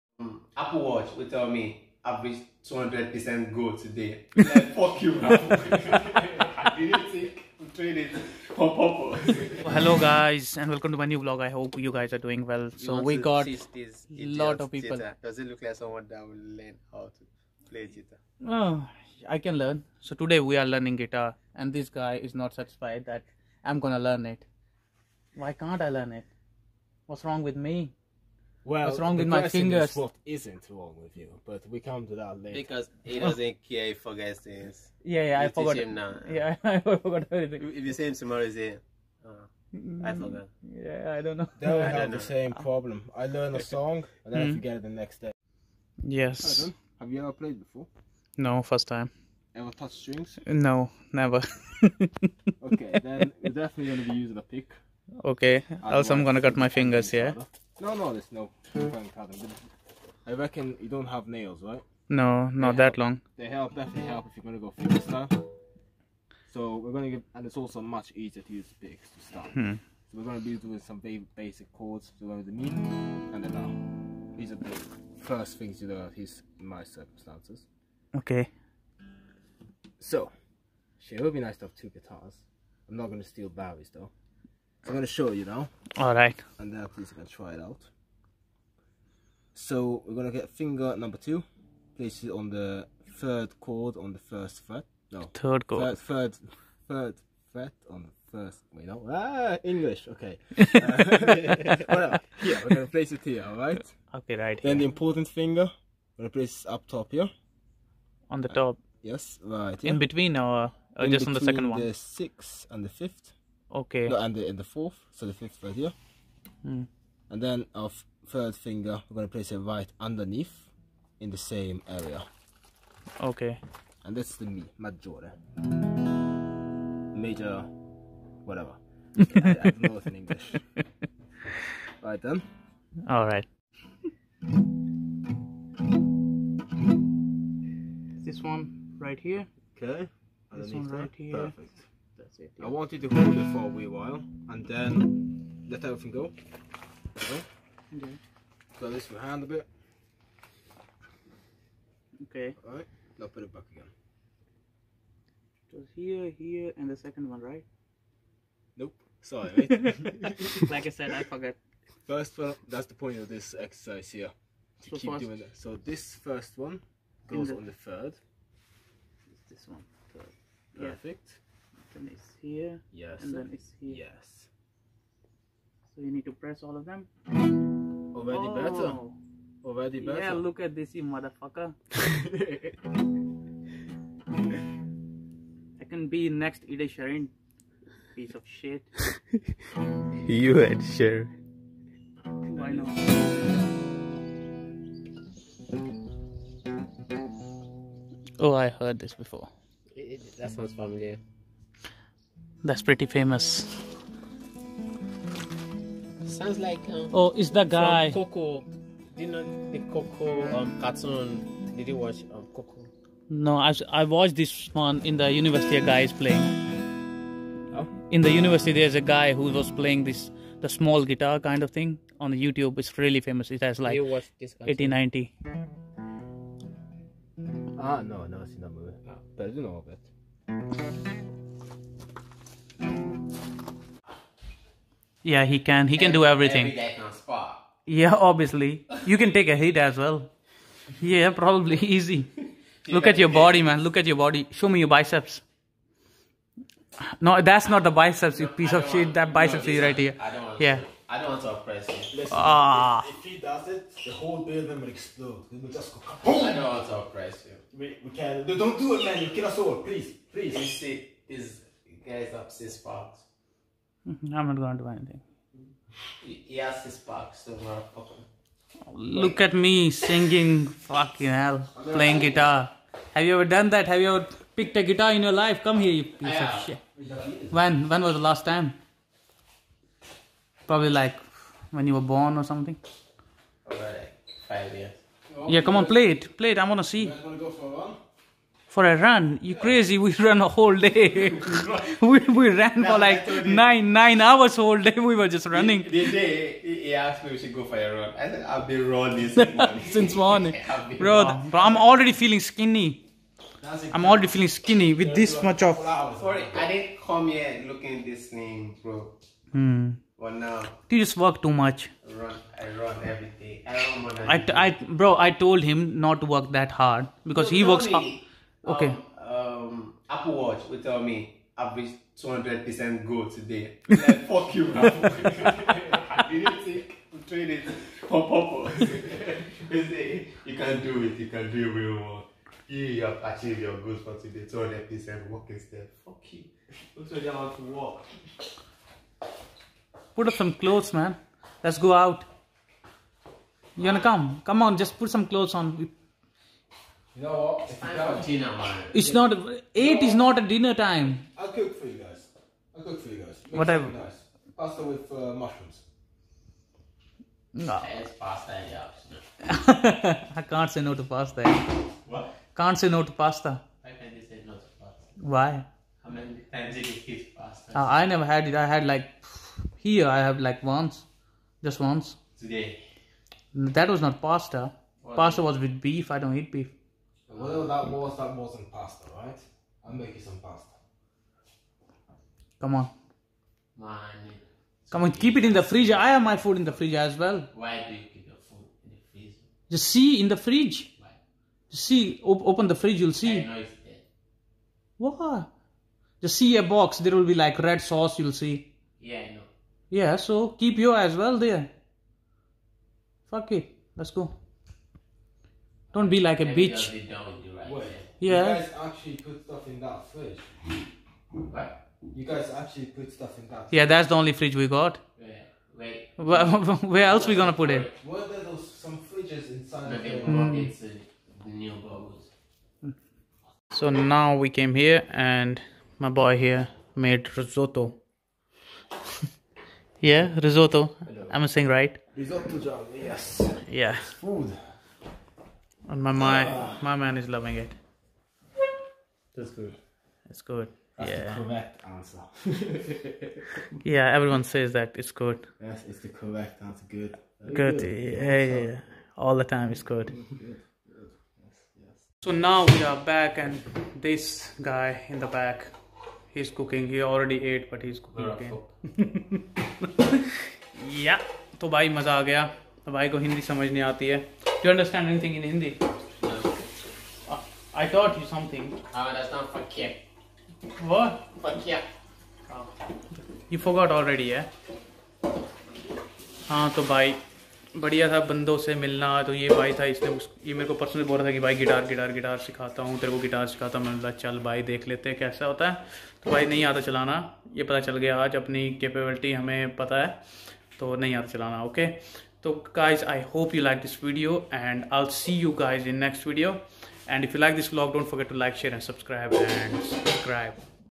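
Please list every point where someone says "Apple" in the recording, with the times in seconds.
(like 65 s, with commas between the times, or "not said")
0 s, 320 s.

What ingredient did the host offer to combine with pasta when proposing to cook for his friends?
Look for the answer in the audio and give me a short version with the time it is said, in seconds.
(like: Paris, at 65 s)
Mushrooms, at 355 s.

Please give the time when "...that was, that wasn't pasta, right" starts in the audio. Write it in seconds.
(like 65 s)
377 s.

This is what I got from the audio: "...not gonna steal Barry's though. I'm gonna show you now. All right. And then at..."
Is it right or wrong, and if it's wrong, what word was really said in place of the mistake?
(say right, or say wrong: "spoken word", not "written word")
right.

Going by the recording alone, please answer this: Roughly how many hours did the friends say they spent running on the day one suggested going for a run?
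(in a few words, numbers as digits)
9 hours.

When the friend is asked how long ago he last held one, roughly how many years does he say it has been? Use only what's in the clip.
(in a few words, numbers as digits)
5 years.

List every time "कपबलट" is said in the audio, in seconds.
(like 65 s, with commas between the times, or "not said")
488 s.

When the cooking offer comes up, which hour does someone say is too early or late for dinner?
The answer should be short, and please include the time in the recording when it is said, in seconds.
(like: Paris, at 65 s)
8, at 349 s.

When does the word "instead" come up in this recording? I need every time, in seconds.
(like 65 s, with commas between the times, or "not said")
335 s.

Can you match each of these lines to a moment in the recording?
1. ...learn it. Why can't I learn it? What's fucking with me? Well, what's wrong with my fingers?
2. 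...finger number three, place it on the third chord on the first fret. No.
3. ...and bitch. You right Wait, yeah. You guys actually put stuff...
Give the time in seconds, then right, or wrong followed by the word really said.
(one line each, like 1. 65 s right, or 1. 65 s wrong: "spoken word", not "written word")
1. 23 s wrong: "wrong", not "fucking"
2. 90 s wrong: "two", not "three"
3. 406 s right.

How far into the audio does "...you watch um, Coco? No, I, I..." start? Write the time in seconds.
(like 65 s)
211 s.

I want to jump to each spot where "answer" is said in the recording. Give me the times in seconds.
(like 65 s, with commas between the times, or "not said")
441 s, 446 s.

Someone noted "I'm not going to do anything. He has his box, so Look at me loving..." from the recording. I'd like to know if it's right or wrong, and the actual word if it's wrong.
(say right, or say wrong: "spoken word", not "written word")
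wrong: "singing", not "loving".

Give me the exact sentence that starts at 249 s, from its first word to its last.
That biceps no, is right here.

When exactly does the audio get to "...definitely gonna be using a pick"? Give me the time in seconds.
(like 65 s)
53 s.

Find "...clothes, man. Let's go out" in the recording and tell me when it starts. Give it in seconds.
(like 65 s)
340 s.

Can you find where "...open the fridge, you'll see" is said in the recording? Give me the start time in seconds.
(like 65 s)
392 s.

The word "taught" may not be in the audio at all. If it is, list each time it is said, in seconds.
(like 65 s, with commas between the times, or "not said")
467 s.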